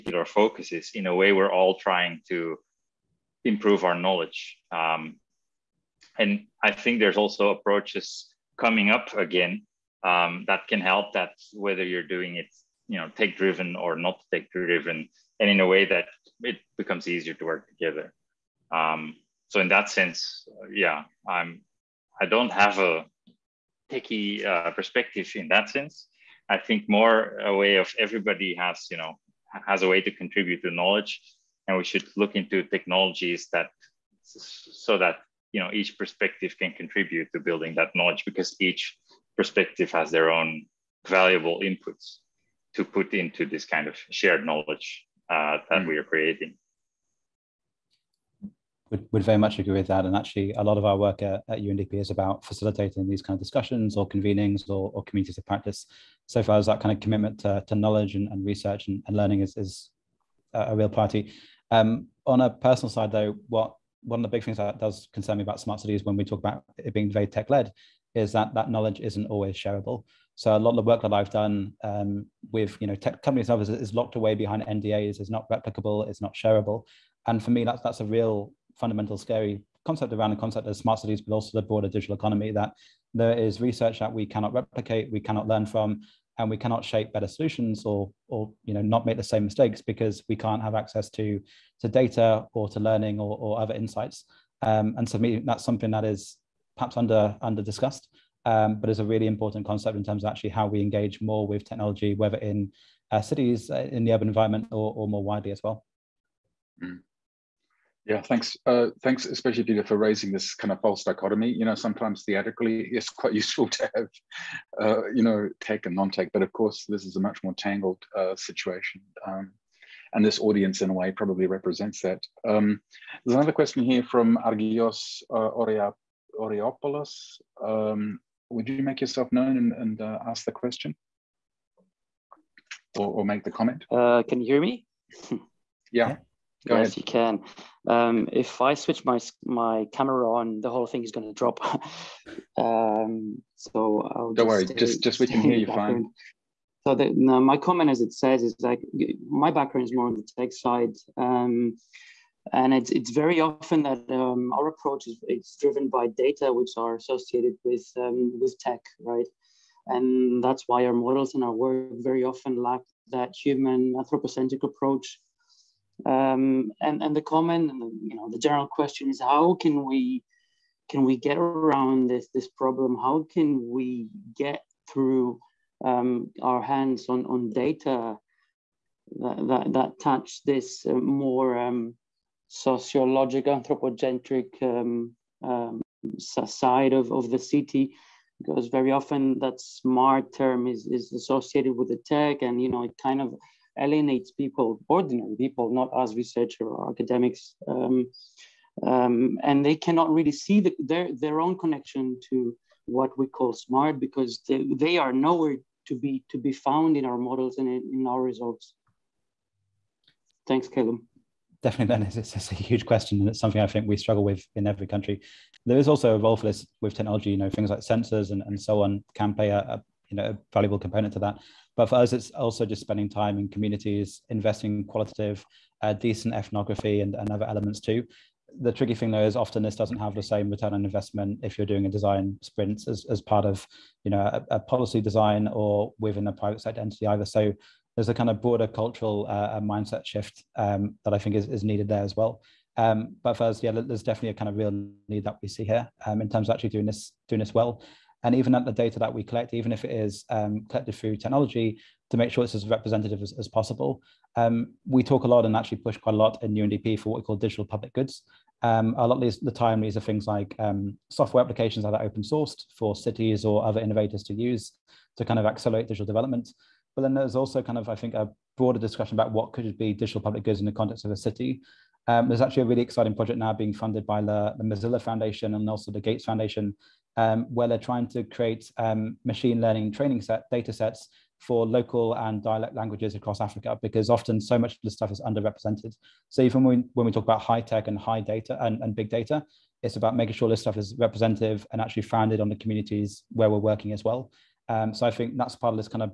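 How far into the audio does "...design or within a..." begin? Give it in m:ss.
3:55.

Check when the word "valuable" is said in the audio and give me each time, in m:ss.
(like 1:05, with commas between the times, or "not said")
0:41, 3:40.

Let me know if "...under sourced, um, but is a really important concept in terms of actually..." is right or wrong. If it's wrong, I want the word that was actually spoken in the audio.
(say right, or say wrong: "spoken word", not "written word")
wrong: "discussed", not "sourced".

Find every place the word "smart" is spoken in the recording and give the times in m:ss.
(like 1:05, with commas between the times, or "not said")
1:05, 1:20, 3:09, 3:23.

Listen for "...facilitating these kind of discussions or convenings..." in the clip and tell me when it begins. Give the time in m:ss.
0:52.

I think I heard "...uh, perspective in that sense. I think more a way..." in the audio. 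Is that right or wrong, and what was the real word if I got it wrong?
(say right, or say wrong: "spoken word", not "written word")
right.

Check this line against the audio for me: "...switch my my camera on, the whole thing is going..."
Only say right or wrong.
right.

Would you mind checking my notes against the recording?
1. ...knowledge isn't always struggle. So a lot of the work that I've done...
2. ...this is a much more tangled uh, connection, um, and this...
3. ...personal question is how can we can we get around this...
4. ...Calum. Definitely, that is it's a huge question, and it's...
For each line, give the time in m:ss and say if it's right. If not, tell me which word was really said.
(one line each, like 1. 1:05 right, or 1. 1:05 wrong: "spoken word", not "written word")
1. 1:08 wrong: "shareable", not "struggle"
2. 1:56 wrong: "situation", not "connection"
3. 2:48 wrong: "general", not "personal"
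4. 3:30 right.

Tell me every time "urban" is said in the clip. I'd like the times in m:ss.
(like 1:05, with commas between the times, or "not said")
1:44.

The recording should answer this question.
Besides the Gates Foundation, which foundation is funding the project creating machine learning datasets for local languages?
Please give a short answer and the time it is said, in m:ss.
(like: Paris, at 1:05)
Mozilla Foundation, at 4:34.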